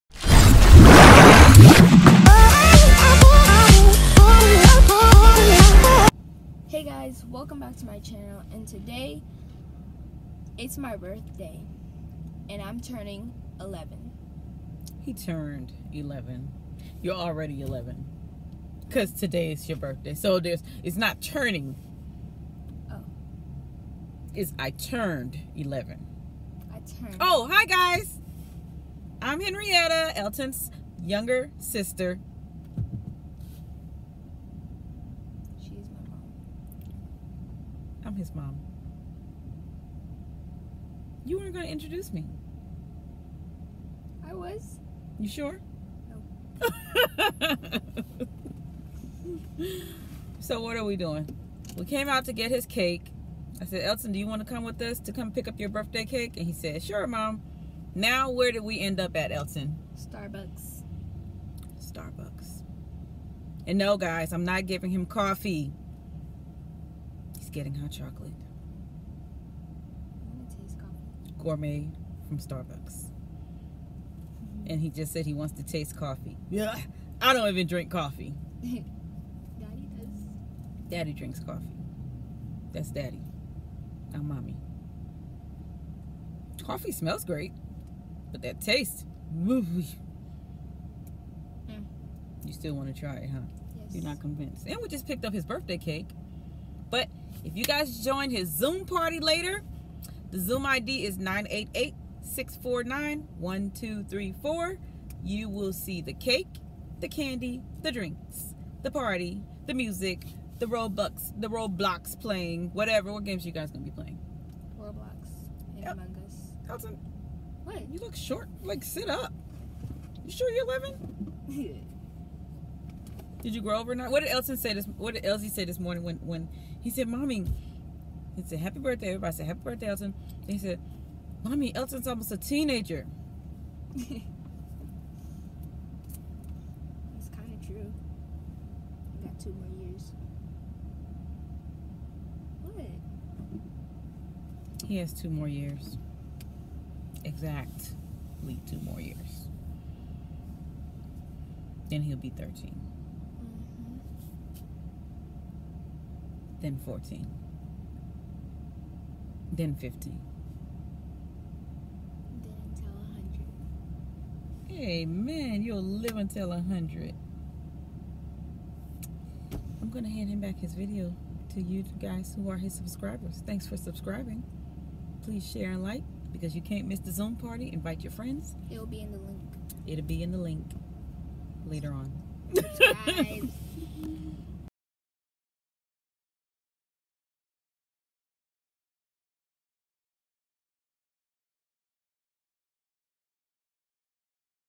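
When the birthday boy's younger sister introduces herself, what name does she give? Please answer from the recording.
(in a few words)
Henrietta.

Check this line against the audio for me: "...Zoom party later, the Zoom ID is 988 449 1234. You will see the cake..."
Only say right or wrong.
wrong.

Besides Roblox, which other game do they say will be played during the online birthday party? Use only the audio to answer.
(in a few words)
Among Us.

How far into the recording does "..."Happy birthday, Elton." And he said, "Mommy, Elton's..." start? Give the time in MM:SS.
02:09.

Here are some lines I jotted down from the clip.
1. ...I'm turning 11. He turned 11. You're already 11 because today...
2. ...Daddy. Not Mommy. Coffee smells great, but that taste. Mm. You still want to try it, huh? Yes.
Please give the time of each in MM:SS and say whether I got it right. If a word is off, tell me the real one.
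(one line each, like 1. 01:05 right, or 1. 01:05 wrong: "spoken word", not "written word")
1. 00:12 right
2. 01:22 right.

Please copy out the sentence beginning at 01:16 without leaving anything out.
Yeah, I don't even drink coffee.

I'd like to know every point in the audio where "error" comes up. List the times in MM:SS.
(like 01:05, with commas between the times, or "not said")
not said.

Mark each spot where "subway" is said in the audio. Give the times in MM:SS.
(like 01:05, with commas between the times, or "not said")
not said.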